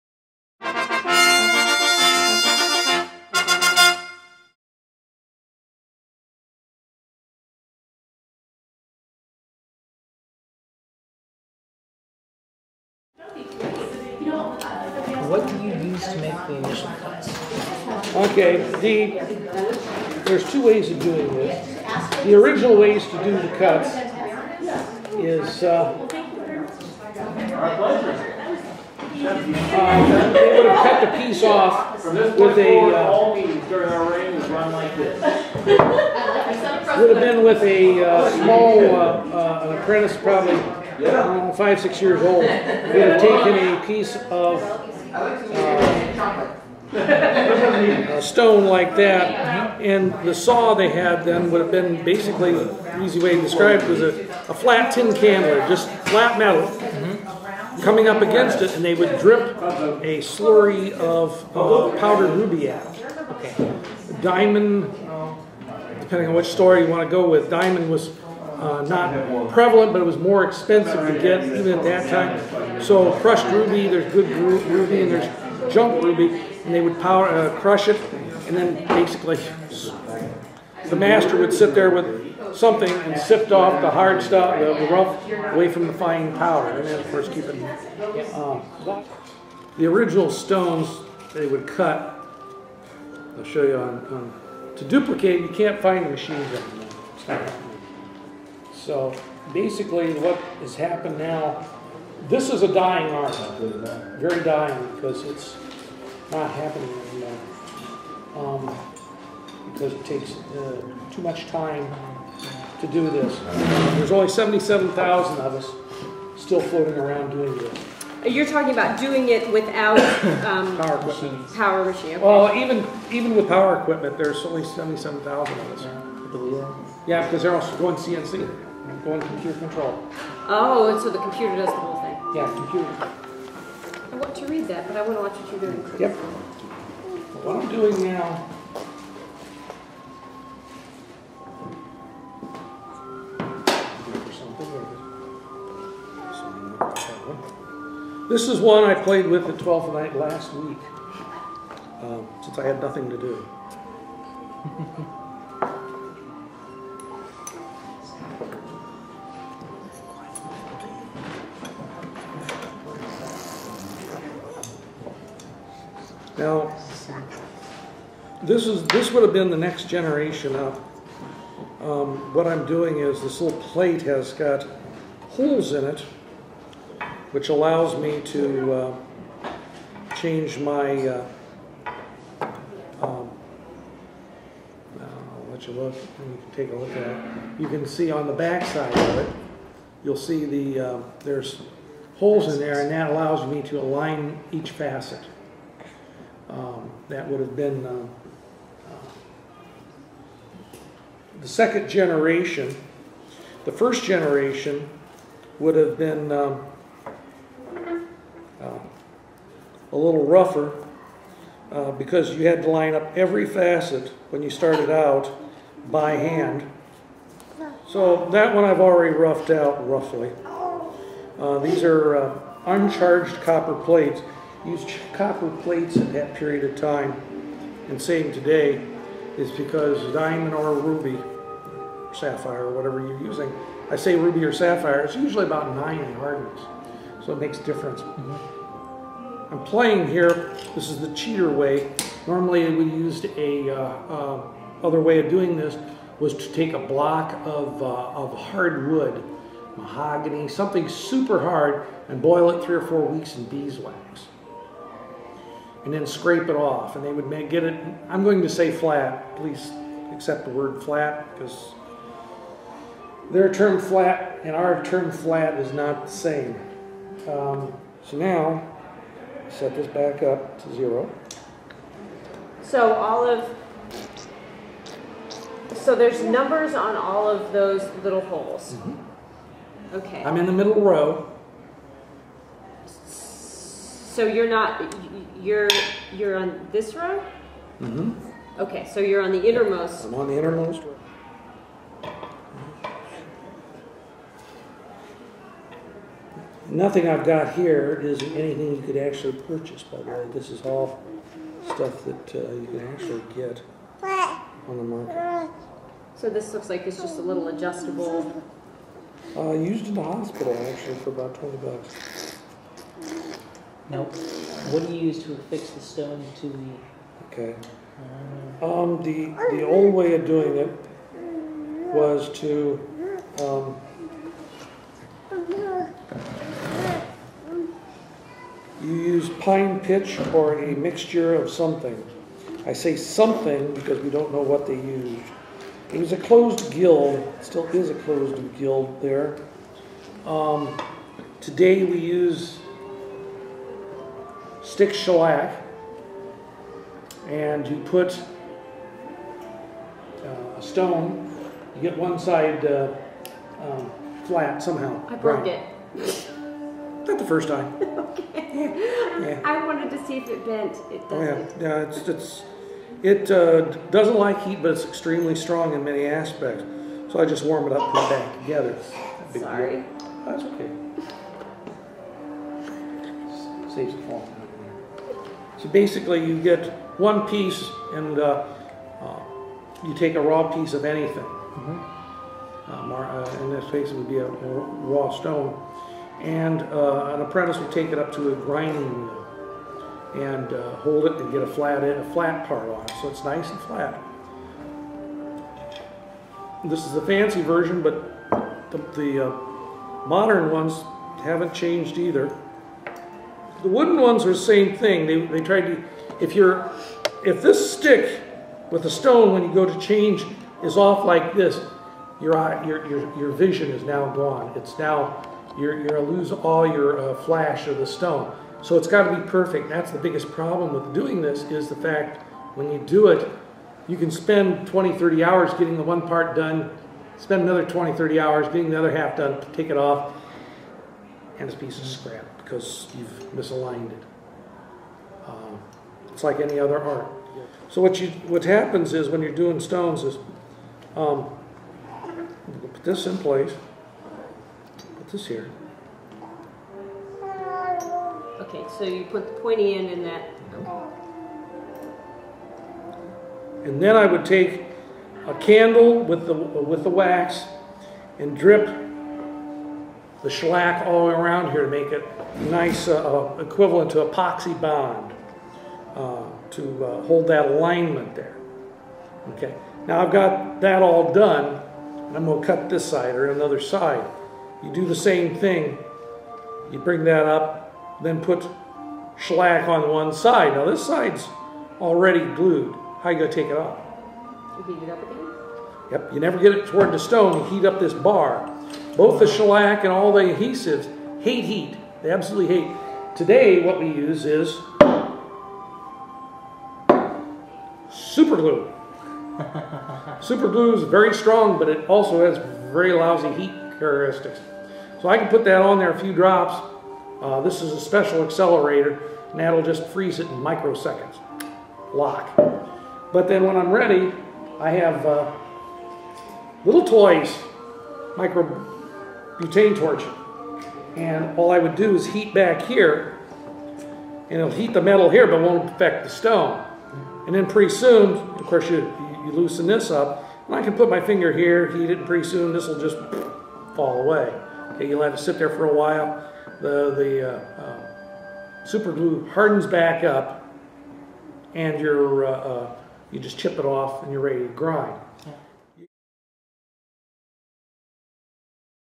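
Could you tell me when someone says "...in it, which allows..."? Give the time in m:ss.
2:55.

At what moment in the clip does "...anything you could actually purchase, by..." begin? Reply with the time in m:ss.
4:58.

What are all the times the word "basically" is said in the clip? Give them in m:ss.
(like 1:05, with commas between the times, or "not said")
0:52, 1:18, 1:39, 6:15.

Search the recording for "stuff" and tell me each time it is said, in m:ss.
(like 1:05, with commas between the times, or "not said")
1:24, 5:01.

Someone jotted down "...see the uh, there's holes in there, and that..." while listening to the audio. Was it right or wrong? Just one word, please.
right.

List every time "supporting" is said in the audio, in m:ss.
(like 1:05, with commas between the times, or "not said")
not said.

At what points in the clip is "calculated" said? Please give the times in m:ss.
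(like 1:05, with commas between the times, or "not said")
not said.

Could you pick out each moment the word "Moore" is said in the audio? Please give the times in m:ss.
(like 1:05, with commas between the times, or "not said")
not said.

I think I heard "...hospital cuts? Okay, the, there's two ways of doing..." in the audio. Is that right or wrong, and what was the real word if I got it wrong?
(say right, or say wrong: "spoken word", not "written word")
wrong: "initial", not "hospital".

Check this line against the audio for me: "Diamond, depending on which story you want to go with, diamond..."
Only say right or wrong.
right.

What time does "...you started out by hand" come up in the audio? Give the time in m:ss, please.
3:34.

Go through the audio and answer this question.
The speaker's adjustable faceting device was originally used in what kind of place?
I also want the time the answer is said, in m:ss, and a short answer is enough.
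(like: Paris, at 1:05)
hospital, at 5:10.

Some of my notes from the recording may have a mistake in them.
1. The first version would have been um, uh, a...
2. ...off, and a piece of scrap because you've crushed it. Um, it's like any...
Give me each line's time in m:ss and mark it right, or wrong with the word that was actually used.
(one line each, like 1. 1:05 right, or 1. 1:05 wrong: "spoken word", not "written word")
1. 3:23 wrong: "generation", not "version"
2. 7:09 wrong: "misaligned", not "crushed".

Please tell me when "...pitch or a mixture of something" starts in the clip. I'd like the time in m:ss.
5:29.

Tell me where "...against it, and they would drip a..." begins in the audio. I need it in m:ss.
0:58.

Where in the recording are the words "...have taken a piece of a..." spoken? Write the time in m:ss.
0:43.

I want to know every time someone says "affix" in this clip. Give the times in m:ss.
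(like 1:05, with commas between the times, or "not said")
5:15.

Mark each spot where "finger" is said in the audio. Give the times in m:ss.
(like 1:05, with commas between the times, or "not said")
8:51.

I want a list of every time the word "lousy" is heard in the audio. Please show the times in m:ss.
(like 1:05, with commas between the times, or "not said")
8:22.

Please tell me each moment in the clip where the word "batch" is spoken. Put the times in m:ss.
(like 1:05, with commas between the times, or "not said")
not said.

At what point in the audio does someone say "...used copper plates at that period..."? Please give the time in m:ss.
3:44.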